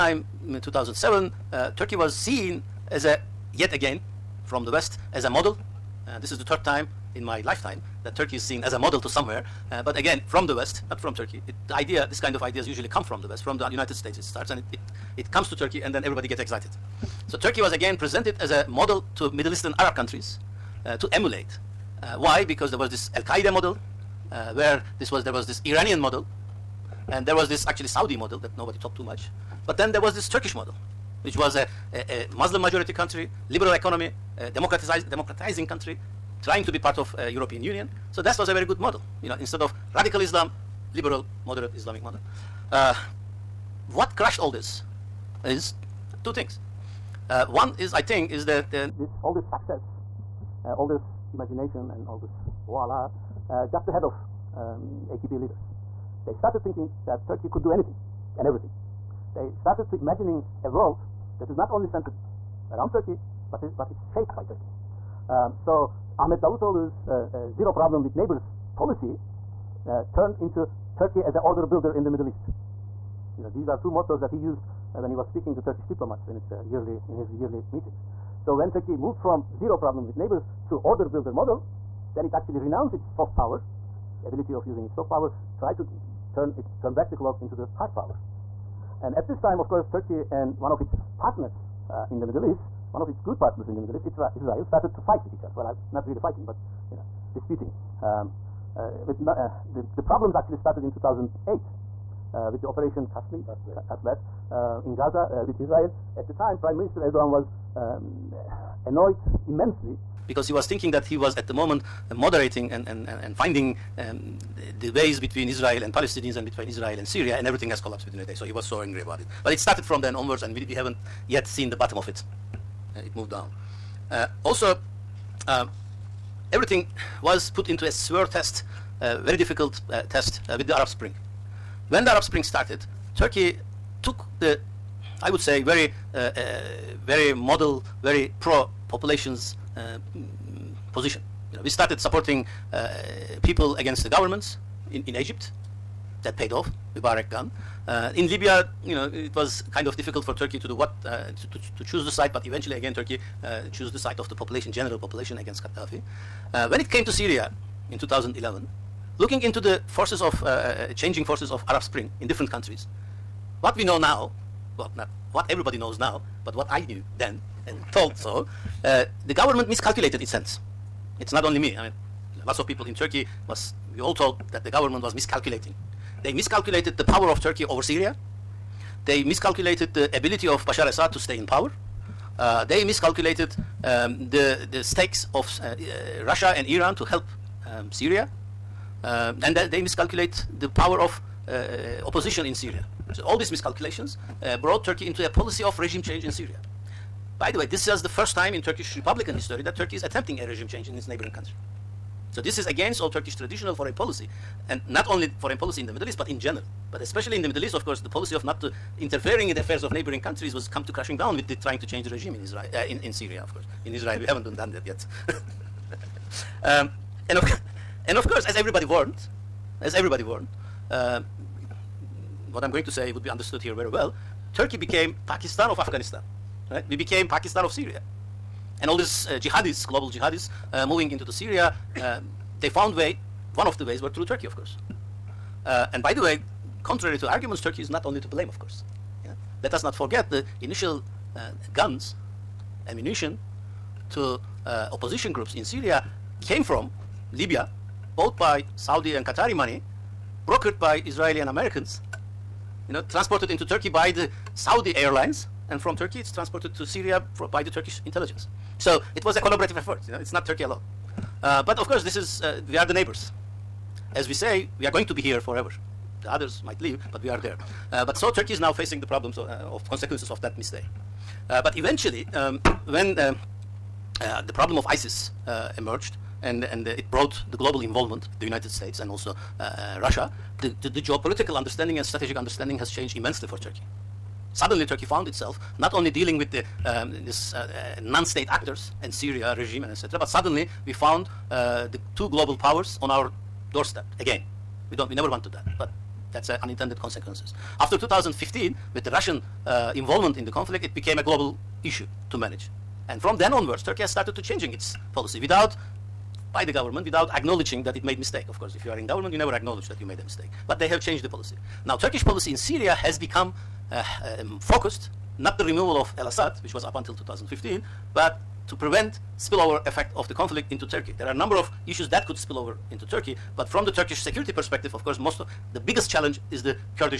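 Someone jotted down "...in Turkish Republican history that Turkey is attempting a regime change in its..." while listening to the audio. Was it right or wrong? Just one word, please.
right.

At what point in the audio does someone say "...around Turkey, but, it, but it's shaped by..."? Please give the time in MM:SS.
01:02.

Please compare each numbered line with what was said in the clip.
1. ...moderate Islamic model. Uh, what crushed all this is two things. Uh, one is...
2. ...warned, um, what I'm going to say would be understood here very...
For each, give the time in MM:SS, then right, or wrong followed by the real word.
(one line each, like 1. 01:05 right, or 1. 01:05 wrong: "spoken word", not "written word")
1. 00:41 right
2. 03:40 right.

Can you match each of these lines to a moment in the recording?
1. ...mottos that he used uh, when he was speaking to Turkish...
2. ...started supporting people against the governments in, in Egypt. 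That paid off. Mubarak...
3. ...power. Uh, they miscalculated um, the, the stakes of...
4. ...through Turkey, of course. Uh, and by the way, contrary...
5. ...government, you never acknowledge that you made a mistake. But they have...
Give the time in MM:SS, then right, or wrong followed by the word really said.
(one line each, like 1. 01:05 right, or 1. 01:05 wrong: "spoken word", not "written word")
1. 01:13 right
2. 02:21 right
3. 03:01 right
4. 03:54 right
5. 05:09 right.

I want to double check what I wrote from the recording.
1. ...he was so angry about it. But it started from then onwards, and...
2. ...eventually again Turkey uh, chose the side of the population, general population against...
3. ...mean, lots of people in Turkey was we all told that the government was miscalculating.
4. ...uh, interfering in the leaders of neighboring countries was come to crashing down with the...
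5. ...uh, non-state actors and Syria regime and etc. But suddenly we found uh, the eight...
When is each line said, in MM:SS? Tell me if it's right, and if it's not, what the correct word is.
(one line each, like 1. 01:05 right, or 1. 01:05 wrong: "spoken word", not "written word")
1. 01:58 right
2. 02:32 right
3. 02:51 right
4. 03:28 wrong: "affairs", not "leaders"
5. 04:47 wrong: "two", not "eight".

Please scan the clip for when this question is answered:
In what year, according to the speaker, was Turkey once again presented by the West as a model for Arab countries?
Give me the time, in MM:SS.
00:00.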